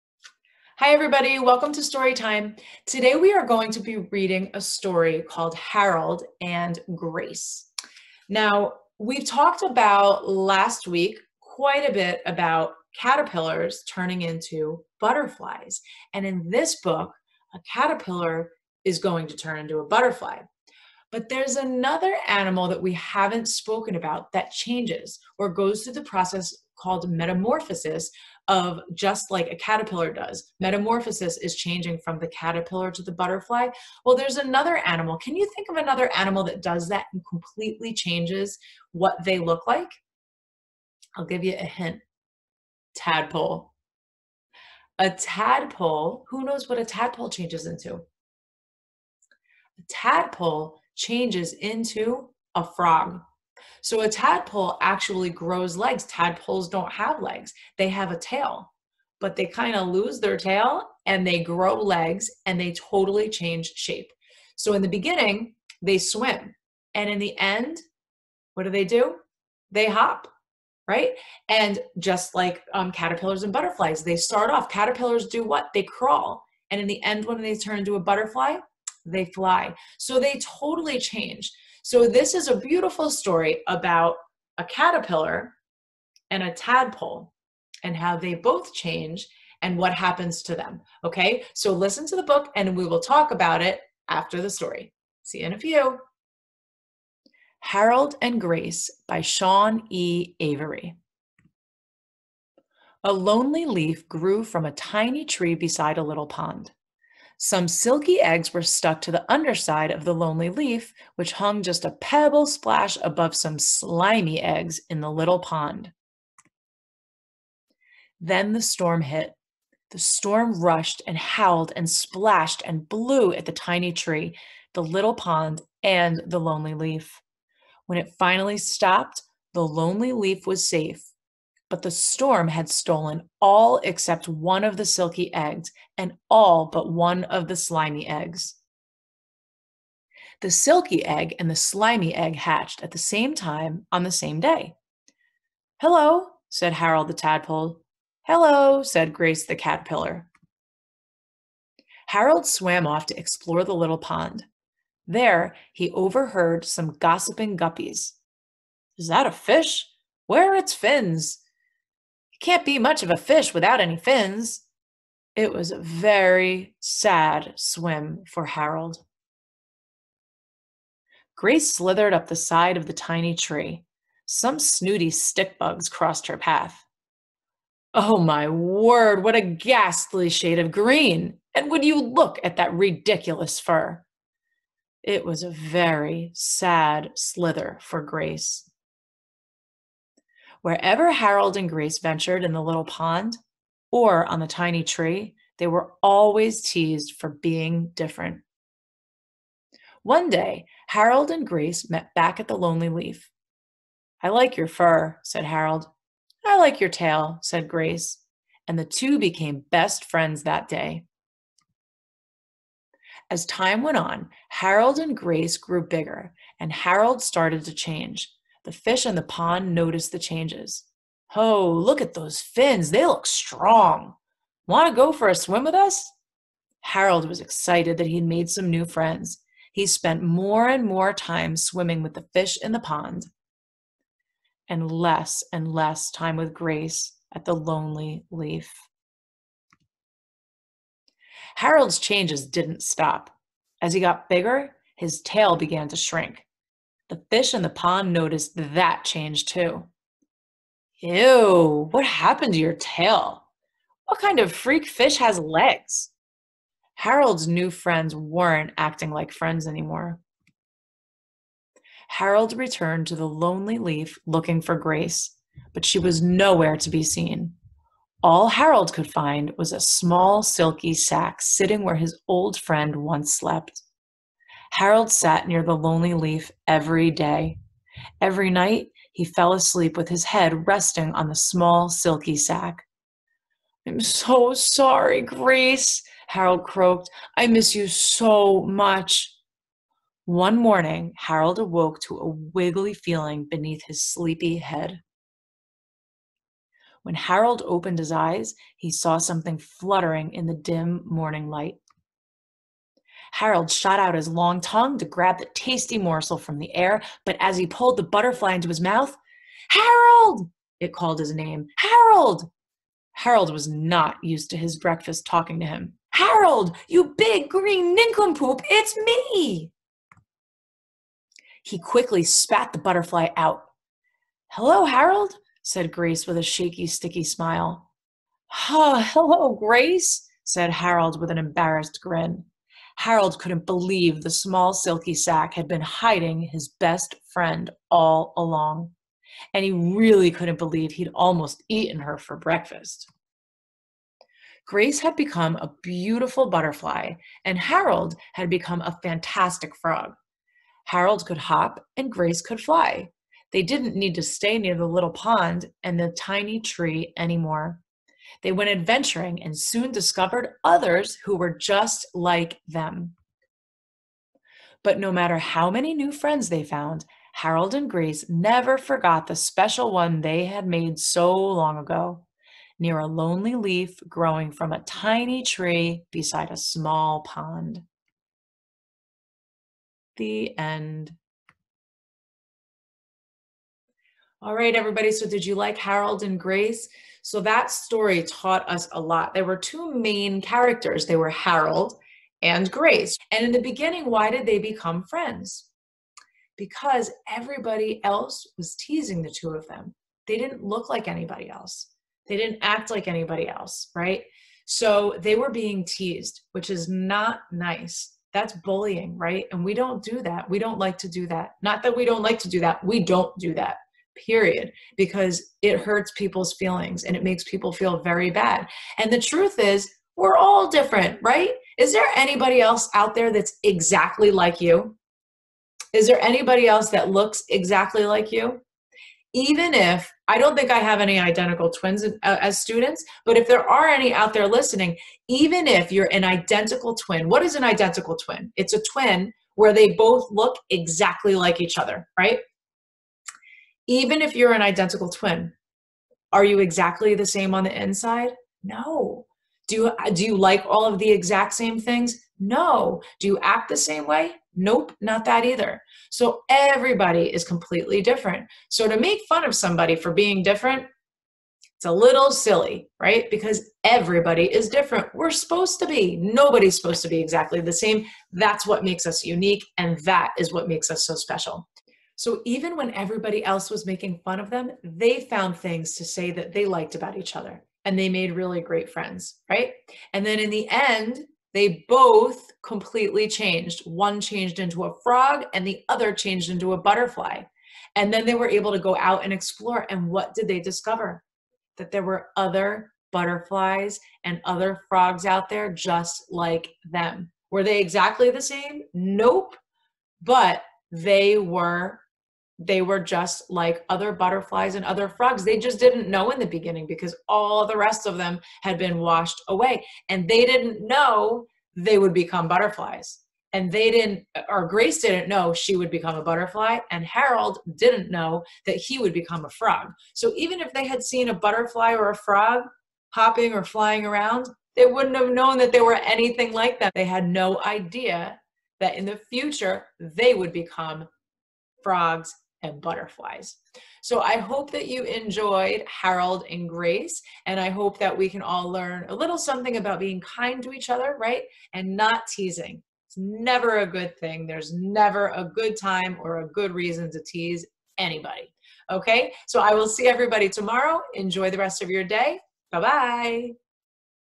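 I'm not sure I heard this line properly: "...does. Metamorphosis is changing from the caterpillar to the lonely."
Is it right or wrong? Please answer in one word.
wrong.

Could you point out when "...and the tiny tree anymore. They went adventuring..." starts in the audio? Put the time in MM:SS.
05:55.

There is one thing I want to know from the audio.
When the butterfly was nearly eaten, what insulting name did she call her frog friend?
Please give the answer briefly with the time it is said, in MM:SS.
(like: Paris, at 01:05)
Nincompoop, at 05:17.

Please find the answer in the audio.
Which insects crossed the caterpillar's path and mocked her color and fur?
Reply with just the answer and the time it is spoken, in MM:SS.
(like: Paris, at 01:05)
Stick bugs, at 02:55.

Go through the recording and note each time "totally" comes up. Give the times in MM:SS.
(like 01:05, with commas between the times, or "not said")
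01:02, 01:20.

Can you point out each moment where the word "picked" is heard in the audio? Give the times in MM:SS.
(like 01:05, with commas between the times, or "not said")
not said.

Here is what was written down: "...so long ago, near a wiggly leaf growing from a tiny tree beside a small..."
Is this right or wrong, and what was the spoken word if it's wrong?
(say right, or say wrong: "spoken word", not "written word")
wrong: "lonely", not "wiggly".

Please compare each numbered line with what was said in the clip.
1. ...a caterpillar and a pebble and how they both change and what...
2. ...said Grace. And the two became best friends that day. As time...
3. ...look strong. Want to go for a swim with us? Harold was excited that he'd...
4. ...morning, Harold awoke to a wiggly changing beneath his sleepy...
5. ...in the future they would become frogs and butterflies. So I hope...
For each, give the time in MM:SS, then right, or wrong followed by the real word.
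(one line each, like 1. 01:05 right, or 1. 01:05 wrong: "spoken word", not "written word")
1. 01:24 wrong: "tadpole", not "pebble"
2. 03:27 right
3. 03:43 right
4. 04:50 wrong: "feeling", not "changing"
5. 08:48 right.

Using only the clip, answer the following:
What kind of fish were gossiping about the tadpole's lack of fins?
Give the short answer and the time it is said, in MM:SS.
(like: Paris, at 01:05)
Guppies, at 02:37.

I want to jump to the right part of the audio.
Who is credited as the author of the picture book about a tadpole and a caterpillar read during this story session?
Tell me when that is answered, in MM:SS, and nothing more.
01:39.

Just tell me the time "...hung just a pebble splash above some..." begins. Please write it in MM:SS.
01:51.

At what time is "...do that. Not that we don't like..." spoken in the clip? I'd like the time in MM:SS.
06:51.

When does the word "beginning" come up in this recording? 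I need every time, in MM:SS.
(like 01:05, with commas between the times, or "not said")
01:04, 06:33, 08:26.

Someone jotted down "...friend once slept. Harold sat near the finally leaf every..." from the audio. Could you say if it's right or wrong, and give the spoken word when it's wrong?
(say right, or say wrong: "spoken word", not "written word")
wrong: "lonely", not "finally".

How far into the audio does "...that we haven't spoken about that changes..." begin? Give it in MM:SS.
00:22.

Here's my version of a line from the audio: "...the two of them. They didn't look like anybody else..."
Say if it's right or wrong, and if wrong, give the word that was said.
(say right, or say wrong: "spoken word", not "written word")
right.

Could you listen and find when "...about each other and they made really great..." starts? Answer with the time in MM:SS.
07:56.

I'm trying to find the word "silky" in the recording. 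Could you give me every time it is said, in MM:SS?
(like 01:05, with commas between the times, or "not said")
01:47, 02:14, 02:20, 04:30, 04:41, 05:34.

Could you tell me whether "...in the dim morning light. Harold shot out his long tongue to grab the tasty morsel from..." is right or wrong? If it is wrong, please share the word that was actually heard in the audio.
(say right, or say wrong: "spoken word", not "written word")
right.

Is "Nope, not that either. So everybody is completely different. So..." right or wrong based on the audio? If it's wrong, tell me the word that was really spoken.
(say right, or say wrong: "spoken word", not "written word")
right.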